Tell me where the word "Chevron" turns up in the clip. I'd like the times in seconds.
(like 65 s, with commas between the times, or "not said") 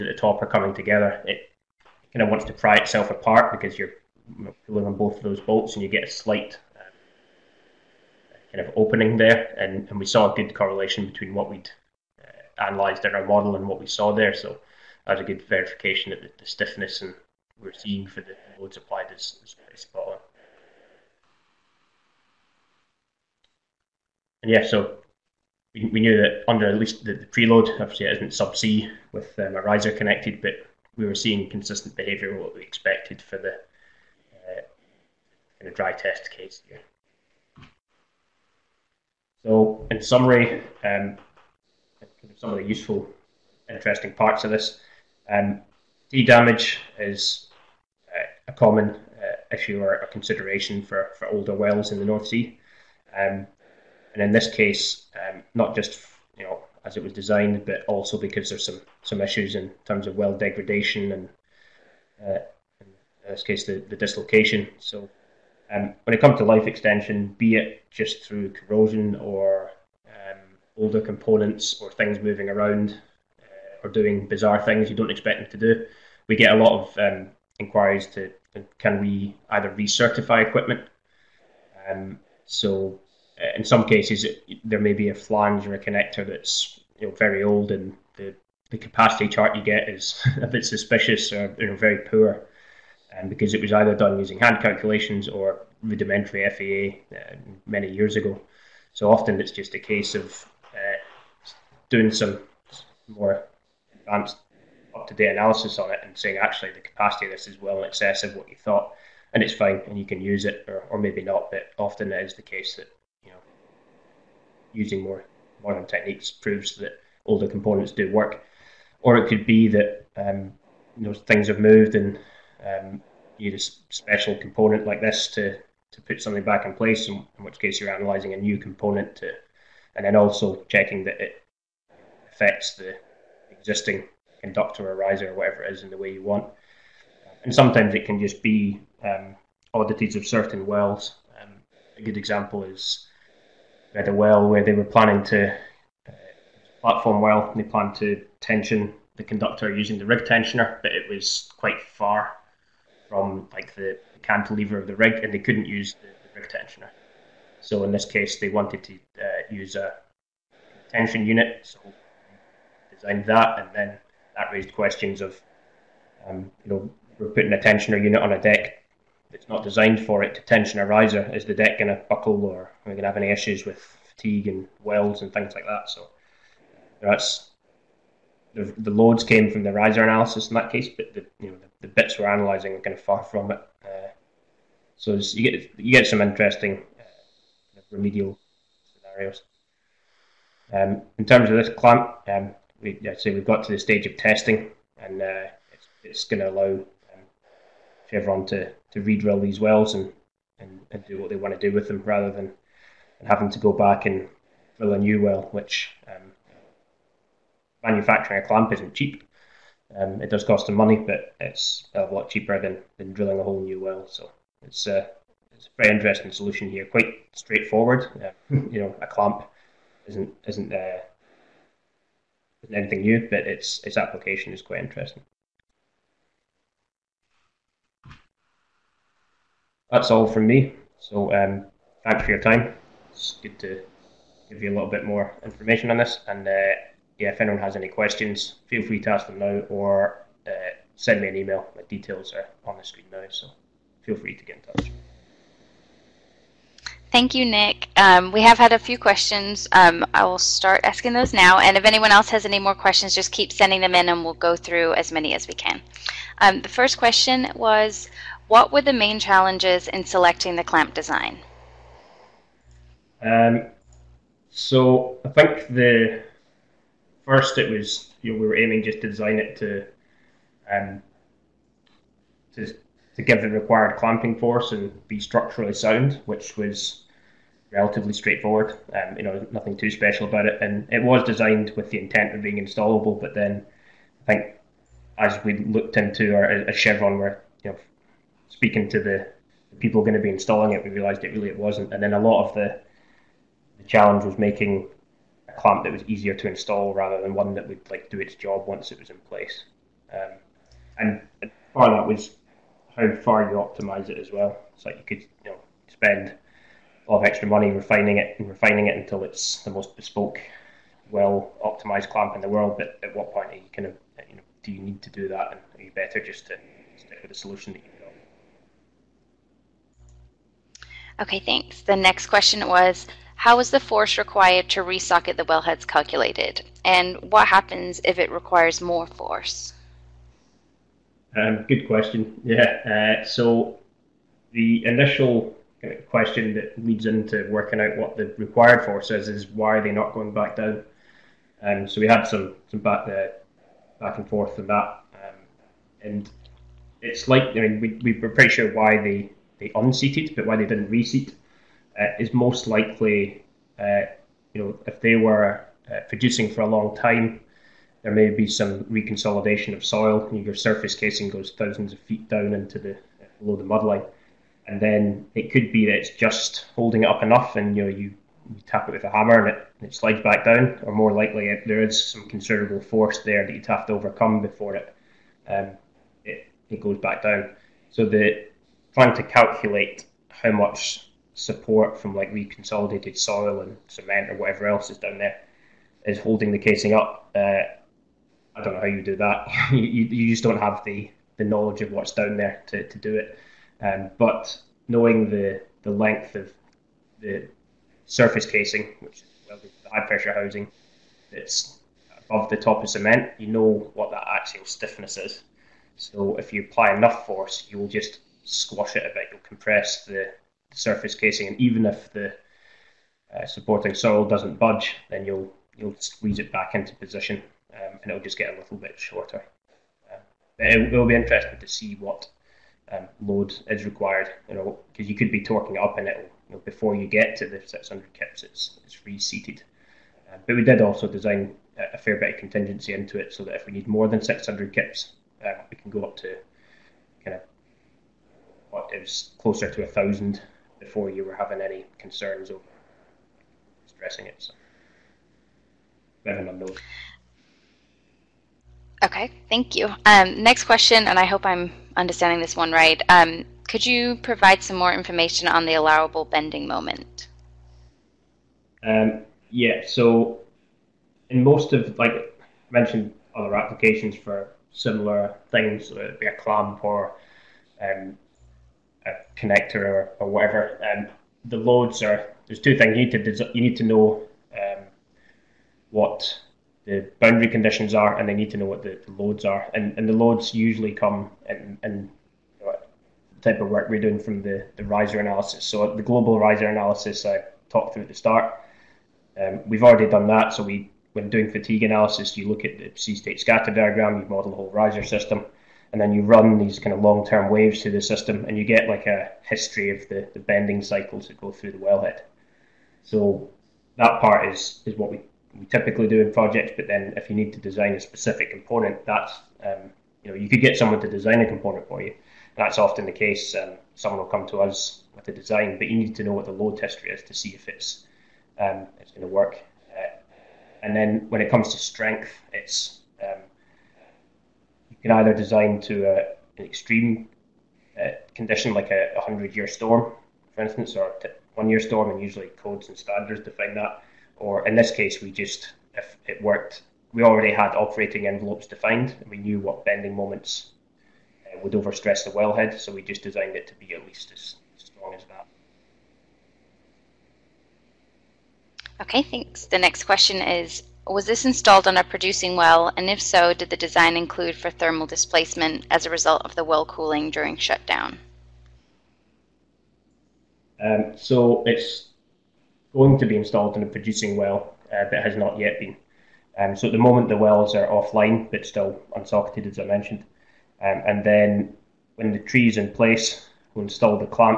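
198 s, 286 s.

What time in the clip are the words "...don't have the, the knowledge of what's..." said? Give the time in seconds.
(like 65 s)
390 s.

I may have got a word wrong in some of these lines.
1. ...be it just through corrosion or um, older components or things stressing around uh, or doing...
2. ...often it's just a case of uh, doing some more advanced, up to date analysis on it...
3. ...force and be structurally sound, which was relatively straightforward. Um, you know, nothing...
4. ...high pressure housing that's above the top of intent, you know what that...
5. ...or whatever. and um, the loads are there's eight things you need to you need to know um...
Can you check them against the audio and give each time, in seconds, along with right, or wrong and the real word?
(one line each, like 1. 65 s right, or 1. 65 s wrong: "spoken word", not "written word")
1. 67 s wrong: "moving", not "stressing"
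2. 99 s right
3. 274 s right
4. 399 s wrong: "cement", not "intent"
5. 470 s wrong: "two", not "eight".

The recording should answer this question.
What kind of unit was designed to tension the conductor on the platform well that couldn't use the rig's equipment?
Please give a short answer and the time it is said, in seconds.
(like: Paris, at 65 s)
tension unit, at 160 s.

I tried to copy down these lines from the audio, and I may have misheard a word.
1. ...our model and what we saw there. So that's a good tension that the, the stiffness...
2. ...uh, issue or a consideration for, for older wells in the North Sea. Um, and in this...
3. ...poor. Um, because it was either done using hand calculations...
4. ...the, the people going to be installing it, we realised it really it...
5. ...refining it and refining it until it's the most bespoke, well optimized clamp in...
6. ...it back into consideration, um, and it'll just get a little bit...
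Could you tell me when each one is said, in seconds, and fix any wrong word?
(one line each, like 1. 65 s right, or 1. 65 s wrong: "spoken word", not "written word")
1. 13 s wrong: "verification", not "tension"
2. 48 s right
3. 91 s right
4. 288 s right
5. 307 s right
6. 416 s wrong: "position", not "consideration".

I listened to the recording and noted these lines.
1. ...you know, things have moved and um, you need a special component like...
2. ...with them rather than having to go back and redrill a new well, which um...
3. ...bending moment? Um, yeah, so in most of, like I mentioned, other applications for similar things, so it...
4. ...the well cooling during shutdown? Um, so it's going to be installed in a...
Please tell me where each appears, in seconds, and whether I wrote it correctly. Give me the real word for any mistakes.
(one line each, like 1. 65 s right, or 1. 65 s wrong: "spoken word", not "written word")
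1. 120 s right
2. 201 s wrong: "drill", not "redrill"
3. 456 s right
4. 556 s right.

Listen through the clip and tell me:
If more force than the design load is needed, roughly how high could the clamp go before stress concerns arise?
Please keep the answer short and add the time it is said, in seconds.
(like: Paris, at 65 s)
1000 kips, at 439 s.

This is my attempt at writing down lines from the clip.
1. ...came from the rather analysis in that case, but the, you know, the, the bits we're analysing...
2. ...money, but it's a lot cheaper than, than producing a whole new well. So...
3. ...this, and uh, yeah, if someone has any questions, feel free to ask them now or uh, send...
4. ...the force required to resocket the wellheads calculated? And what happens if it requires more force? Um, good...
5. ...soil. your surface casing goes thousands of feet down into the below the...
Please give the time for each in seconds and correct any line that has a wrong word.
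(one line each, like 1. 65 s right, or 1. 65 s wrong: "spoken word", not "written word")
1. 179 s wrong: "riser", not "rather"
2. 210 s wrong: "drilling", not "producing"
3. 235 s wrong: "anyone", not "someone"
4. 323 s right
5. 359 s right.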